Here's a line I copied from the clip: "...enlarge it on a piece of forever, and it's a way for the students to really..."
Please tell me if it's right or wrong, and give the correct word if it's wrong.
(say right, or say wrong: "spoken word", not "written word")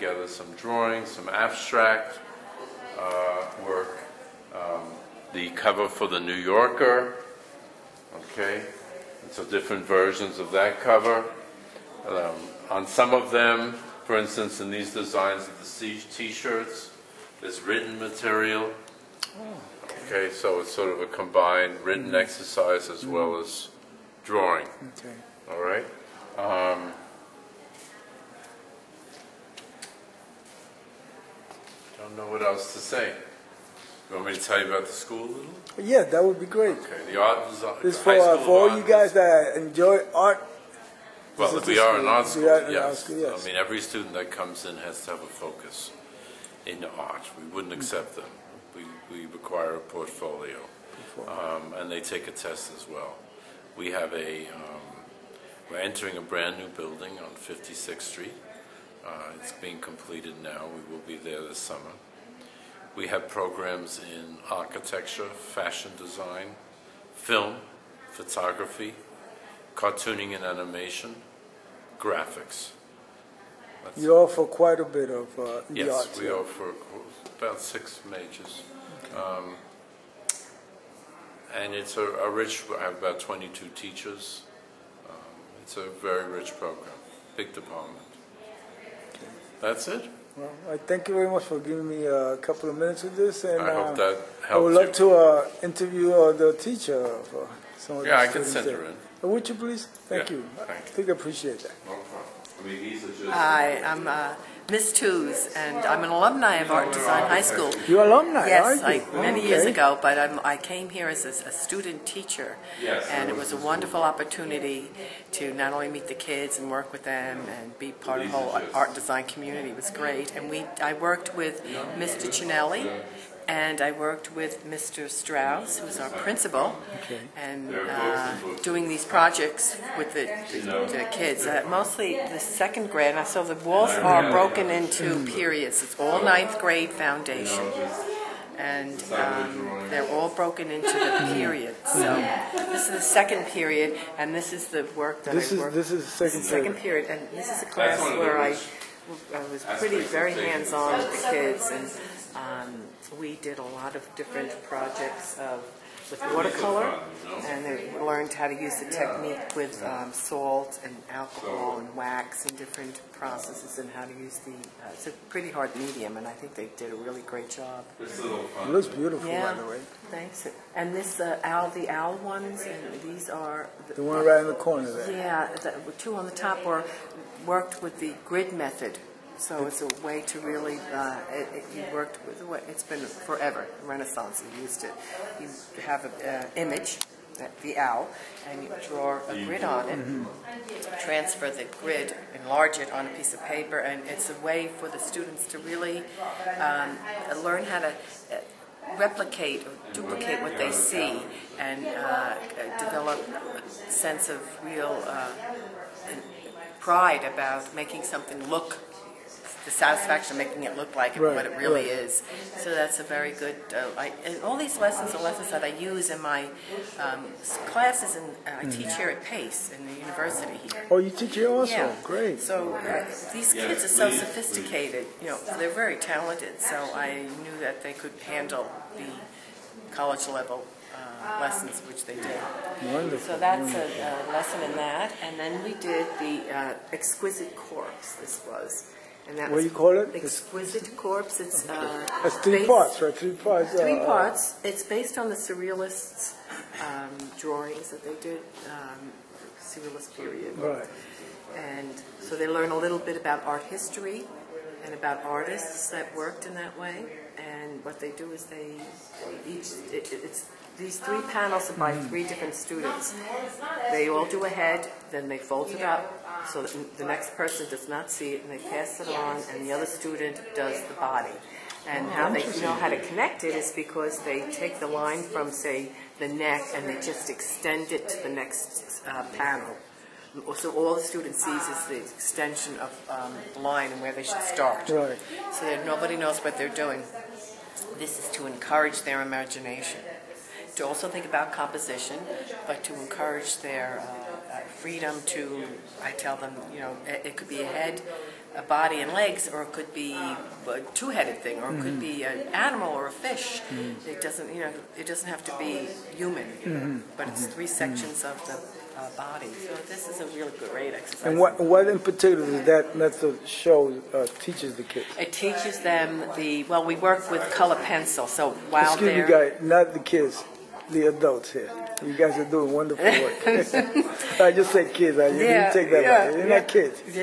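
wrong: "paper", not "forever".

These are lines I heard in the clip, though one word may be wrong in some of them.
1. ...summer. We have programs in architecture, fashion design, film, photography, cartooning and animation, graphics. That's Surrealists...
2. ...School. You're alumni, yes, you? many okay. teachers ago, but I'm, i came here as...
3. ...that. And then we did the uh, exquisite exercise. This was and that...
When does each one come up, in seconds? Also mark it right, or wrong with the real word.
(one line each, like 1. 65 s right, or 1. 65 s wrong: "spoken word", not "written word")
1. 61 s wrong: "You", not "Surrealists"
2. 107 s wrong: "years", not "teachers"
3. 234 s wrong: "corpse", not "exercise".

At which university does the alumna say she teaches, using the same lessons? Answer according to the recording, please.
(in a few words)
Pace.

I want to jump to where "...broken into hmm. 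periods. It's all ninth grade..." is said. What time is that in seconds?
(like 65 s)
134 s.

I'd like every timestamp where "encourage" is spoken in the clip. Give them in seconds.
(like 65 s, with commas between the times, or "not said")
288 s, 292 s.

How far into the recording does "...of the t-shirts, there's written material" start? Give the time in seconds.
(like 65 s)
15 s.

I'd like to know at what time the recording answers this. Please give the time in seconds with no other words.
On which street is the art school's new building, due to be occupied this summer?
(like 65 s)
57 s.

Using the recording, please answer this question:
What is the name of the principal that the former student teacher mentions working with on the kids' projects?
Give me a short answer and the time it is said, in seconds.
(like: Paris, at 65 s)
Mr. Strauss, at 124 s.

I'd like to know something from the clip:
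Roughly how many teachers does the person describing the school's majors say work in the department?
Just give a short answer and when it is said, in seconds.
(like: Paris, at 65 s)
22, at 83 s.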